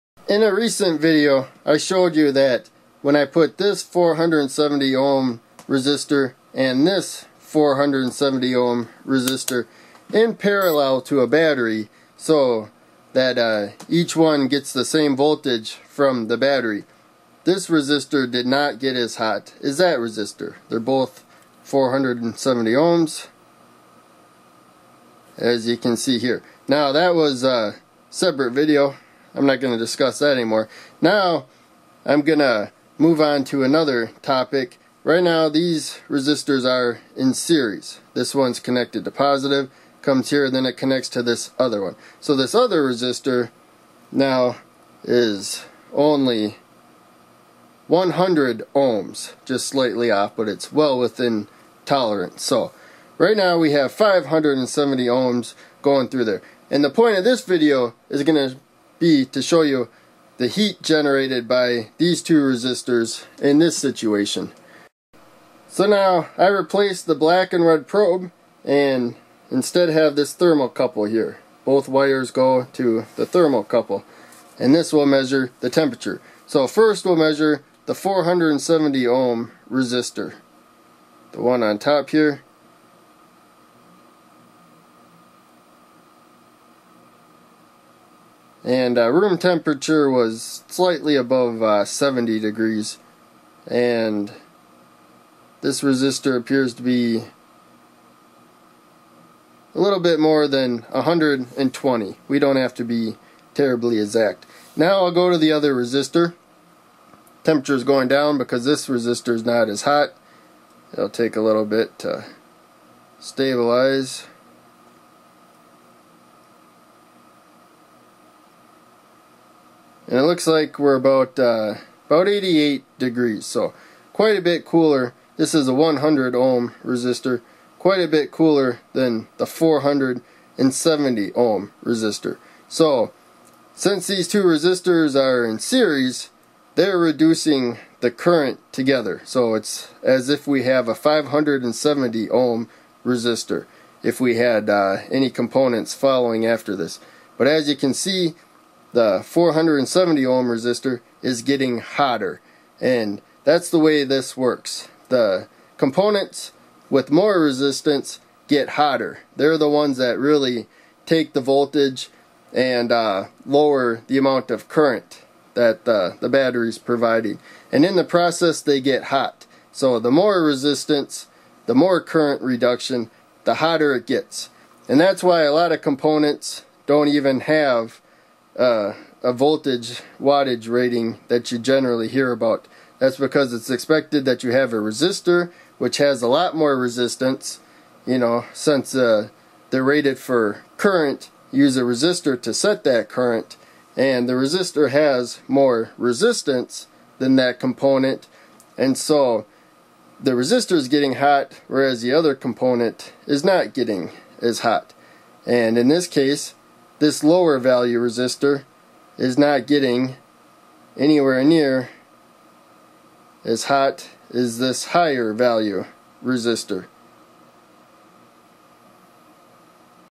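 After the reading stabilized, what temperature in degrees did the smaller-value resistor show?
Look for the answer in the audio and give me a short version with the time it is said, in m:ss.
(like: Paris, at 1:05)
88 degrees, at 2:02.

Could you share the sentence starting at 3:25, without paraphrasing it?
And in this case, this lower value resistor is not getting anywhere near as hot as this higher value resistor.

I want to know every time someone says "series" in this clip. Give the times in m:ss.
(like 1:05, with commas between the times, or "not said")
0:37, 2:15.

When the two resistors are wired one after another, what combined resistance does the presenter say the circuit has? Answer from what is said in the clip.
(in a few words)
570 ohms.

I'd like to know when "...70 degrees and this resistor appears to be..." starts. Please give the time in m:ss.
1:31.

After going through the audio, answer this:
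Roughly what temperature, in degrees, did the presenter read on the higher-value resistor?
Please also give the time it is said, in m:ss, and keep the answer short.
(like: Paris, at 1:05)
120, at 1:40.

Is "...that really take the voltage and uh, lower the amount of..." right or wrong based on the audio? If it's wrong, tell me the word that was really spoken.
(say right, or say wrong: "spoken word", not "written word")
right.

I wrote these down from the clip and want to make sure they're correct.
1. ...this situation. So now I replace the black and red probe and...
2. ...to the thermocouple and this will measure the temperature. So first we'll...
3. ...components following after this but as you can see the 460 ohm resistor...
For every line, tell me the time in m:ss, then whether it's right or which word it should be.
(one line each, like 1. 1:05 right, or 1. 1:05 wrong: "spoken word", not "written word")
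1. 1:03 right
2. 1:12 right
3. 2:25 wrong: "470", not "460".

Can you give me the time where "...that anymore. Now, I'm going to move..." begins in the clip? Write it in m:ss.
0:30.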